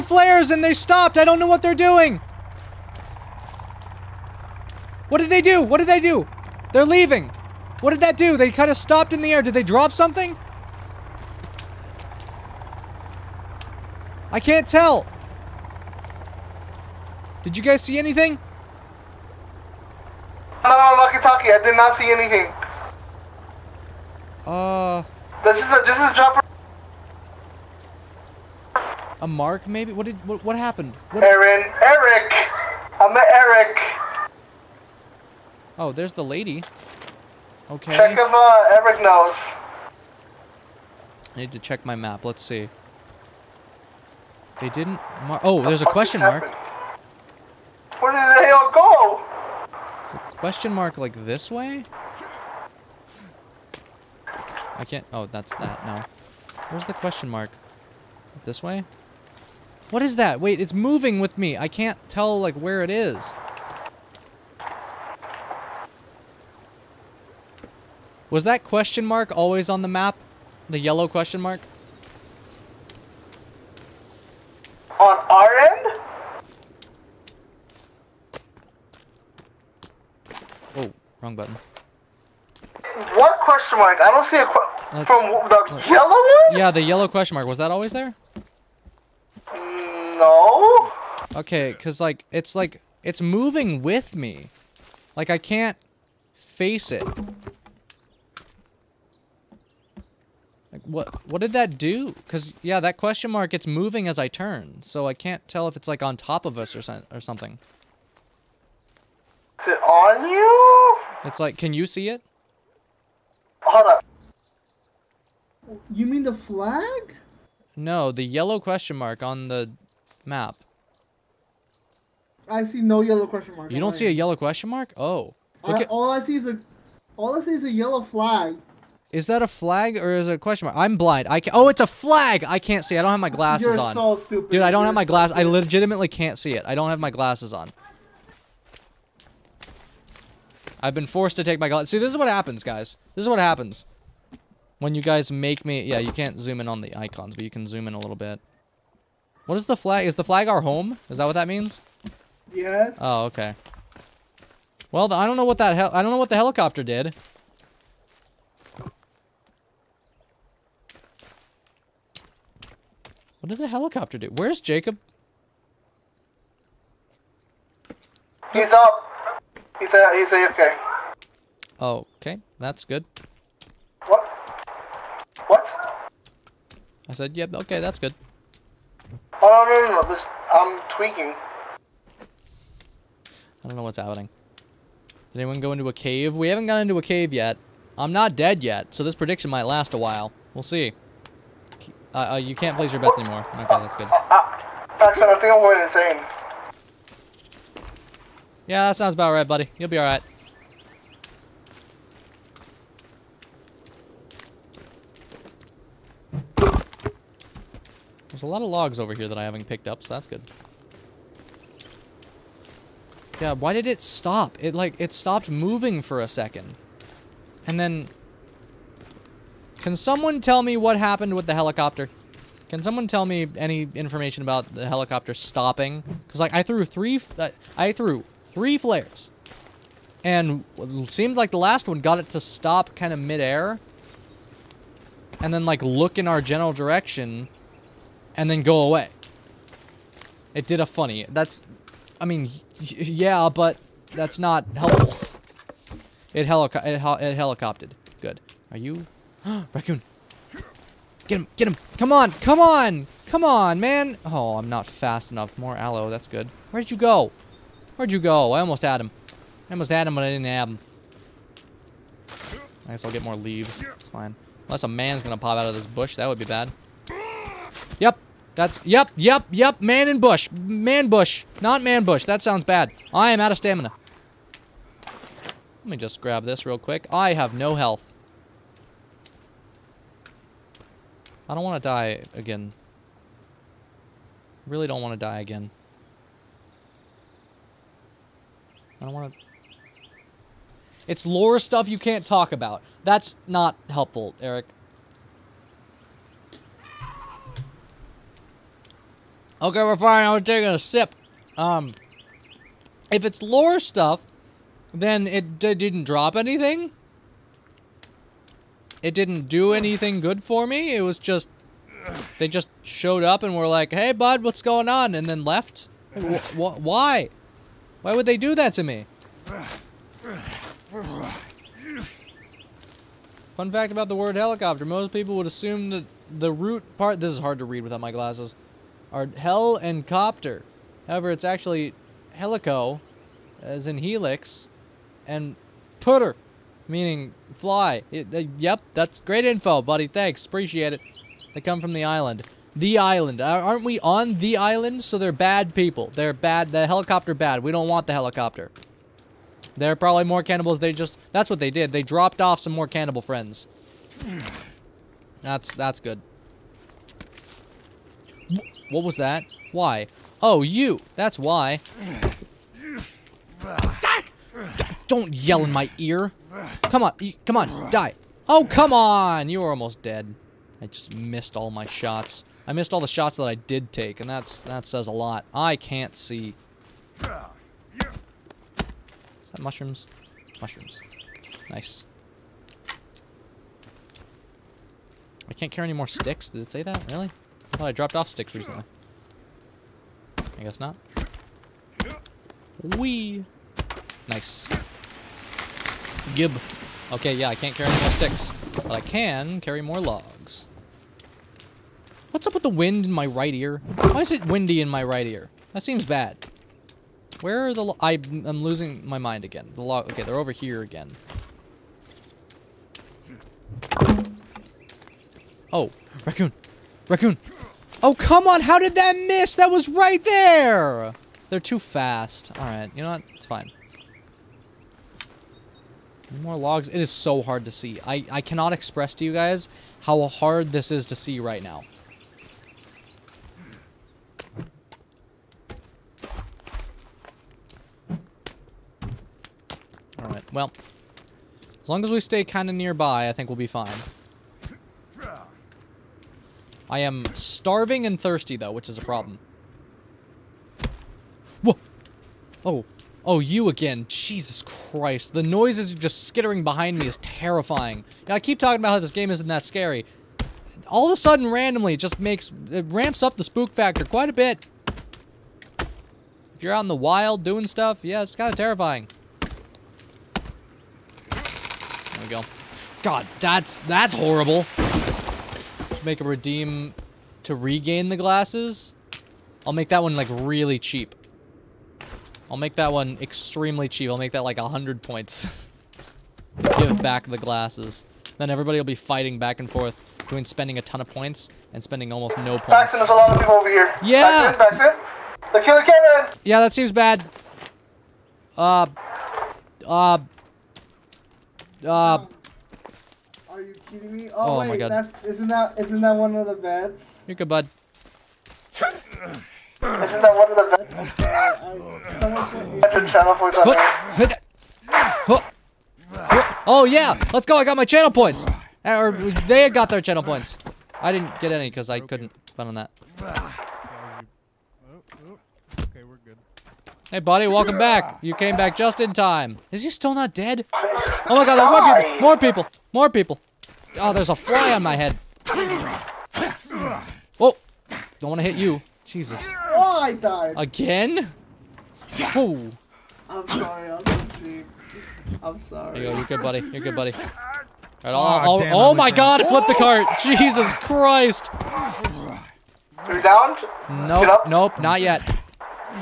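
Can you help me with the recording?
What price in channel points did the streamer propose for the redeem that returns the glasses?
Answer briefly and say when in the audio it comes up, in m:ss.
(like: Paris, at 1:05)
100 points, at 8:04.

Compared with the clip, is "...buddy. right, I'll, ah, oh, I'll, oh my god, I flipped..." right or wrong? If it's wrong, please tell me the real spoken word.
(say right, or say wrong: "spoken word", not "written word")
right.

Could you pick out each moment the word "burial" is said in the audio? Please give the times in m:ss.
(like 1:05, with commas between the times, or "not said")
not said.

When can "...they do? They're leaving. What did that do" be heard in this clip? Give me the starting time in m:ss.
0:05.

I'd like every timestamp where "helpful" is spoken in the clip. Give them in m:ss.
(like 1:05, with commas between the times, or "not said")
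4:04, 4:53.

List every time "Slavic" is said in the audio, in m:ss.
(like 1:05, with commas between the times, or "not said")
not said.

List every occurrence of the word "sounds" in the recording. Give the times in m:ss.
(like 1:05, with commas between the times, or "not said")
3:18, 4:32.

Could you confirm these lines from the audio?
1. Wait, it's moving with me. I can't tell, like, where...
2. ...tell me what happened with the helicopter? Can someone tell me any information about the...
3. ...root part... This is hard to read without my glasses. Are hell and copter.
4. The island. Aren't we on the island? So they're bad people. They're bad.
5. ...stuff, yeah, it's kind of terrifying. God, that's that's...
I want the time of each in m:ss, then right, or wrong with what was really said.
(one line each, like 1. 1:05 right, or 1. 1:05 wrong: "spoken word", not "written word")
1. 1:00 right
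2. 3:40 right
3. 5:26 right
4. 5:42 right
5. 7:47 right.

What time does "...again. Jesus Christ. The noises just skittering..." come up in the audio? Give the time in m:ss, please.
7:33.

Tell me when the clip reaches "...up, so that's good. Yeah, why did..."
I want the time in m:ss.
3:29.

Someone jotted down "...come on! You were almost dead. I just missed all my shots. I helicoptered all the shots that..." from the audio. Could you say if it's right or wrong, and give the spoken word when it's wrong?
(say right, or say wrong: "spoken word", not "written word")
wrong: "missed", not "helicoptered".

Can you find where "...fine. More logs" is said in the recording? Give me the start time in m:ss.
7:03.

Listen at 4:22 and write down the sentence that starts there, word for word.
I guess I'll get more leaves.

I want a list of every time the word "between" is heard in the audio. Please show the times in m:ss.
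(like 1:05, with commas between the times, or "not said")
8:10.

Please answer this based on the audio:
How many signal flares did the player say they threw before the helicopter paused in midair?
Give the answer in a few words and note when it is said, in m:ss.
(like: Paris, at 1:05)
3, at 3:48.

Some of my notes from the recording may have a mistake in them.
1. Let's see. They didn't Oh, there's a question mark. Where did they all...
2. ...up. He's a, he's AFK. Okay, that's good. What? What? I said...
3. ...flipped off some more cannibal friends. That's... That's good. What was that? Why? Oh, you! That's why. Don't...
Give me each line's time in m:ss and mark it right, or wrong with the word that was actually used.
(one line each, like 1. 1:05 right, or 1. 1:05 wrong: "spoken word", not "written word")
1. 0:42 right
2. 2:48 right
3. 5:52 wrong: "dropped", not "flipped".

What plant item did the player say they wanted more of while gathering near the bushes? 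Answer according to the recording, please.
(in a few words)
aloe.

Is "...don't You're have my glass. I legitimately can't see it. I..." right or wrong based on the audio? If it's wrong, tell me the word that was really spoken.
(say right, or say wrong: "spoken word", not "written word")
right.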